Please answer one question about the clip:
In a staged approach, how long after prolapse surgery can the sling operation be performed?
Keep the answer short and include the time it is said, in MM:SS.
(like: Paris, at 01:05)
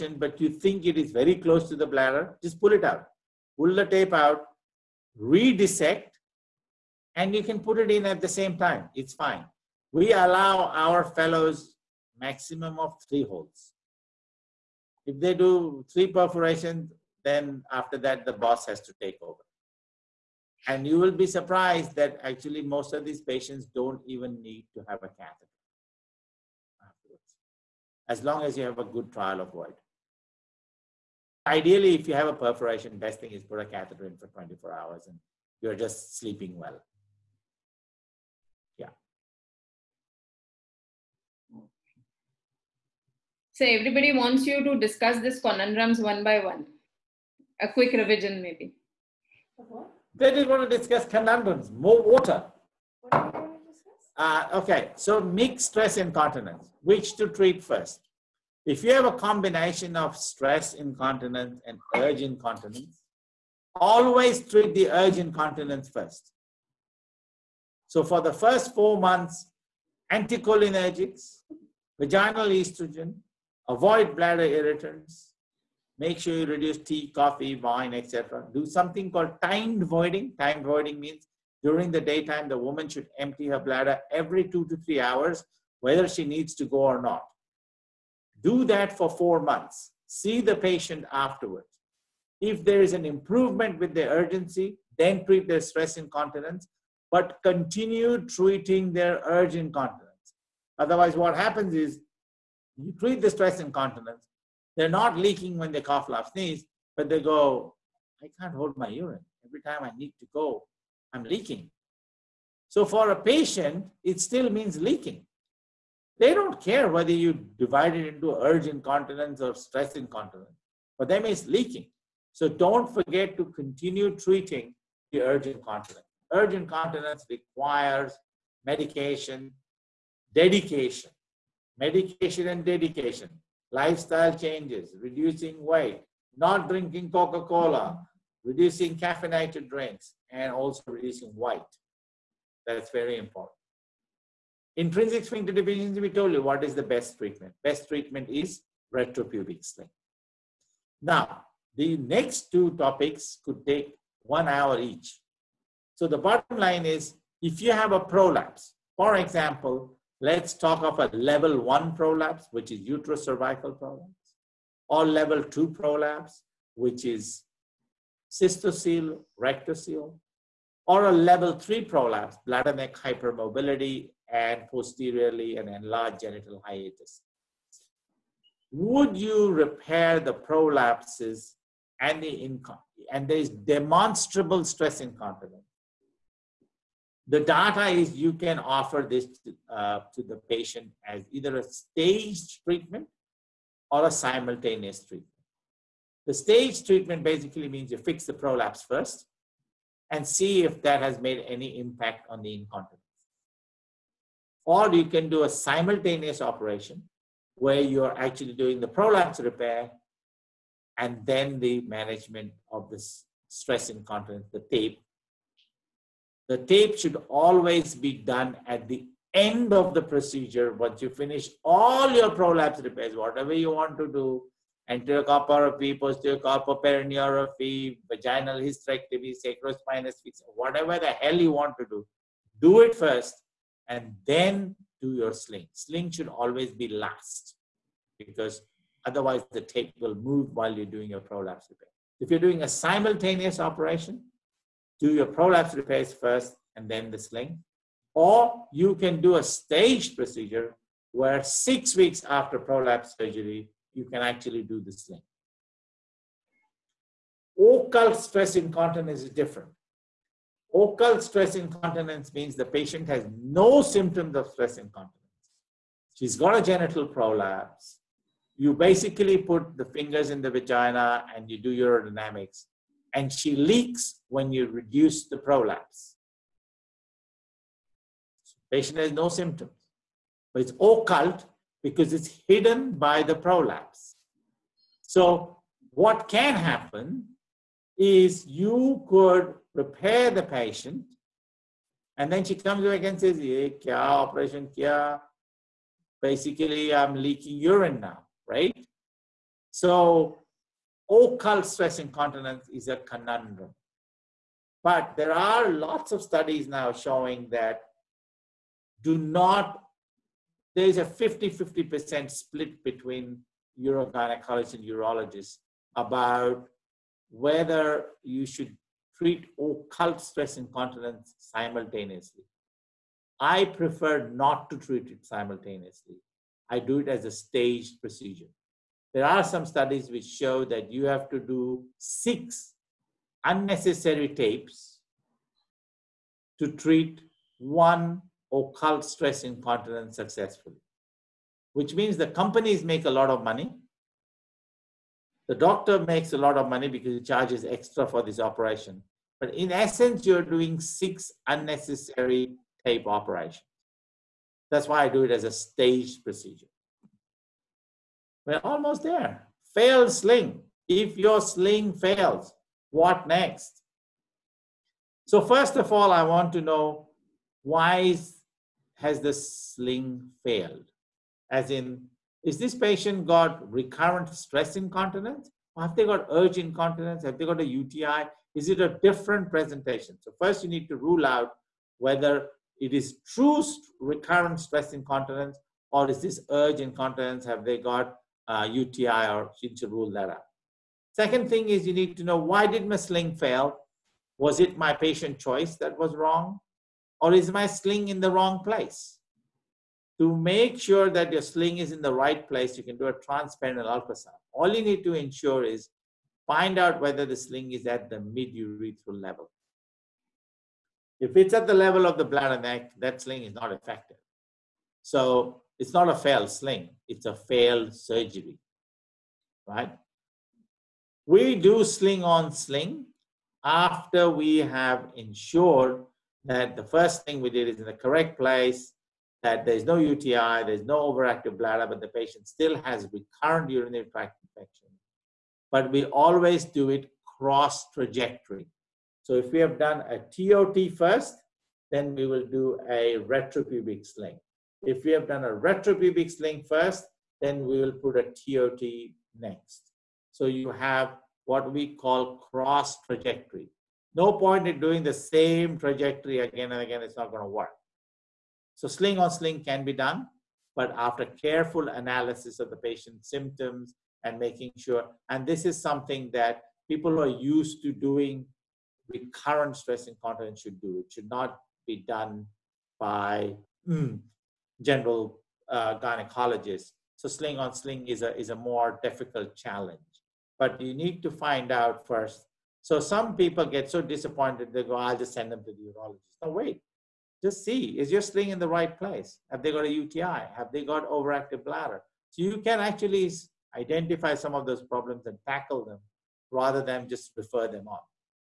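6 weeks, at 04:11.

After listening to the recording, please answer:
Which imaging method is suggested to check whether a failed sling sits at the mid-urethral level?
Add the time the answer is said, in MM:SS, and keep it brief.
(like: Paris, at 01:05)
transperineal ultrasound, at 06:43.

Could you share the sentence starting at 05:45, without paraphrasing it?
The doctor makes a lot of money because he charges extra for this operation.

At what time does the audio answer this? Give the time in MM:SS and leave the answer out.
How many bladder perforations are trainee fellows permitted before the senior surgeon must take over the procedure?
00:13.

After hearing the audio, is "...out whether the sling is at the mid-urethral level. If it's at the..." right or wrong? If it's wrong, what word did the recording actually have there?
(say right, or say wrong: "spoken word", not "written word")
right.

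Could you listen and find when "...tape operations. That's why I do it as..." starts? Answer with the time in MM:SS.
05:52.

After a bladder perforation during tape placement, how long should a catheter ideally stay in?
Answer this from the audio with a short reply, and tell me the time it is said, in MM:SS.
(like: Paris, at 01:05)
24 hours, at 00:34.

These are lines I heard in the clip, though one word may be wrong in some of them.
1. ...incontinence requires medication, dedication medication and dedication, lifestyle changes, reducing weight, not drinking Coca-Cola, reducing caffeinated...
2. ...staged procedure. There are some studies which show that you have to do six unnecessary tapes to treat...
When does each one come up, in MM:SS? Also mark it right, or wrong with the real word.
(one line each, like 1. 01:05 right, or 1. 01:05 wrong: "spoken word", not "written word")
1. 02:06 right
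2. 05:27 right.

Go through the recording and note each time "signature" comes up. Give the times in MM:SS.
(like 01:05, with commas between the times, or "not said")
not said.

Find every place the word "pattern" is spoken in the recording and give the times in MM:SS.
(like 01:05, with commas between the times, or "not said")
not said.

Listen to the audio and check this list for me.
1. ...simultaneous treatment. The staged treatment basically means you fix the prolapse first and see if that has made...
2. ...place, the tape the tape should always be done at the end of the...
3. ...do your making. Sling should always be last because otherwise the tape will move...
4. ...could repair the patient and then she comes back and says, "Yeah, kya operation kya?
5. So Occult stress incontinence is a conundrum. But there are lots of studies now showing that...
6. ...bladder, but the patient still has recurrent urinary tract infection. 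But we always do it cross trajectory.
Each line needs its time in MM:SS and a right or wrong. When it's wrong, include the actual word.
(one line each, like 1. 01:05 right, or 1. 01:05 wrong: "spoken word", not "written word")
1. 03:14 right
2. 03:33 wrong: "incontinence", not "place"
3. 03:55 wrong: "sling", not "making"
4. 04:49 right
5. 04:59 right
6. 07:11 right.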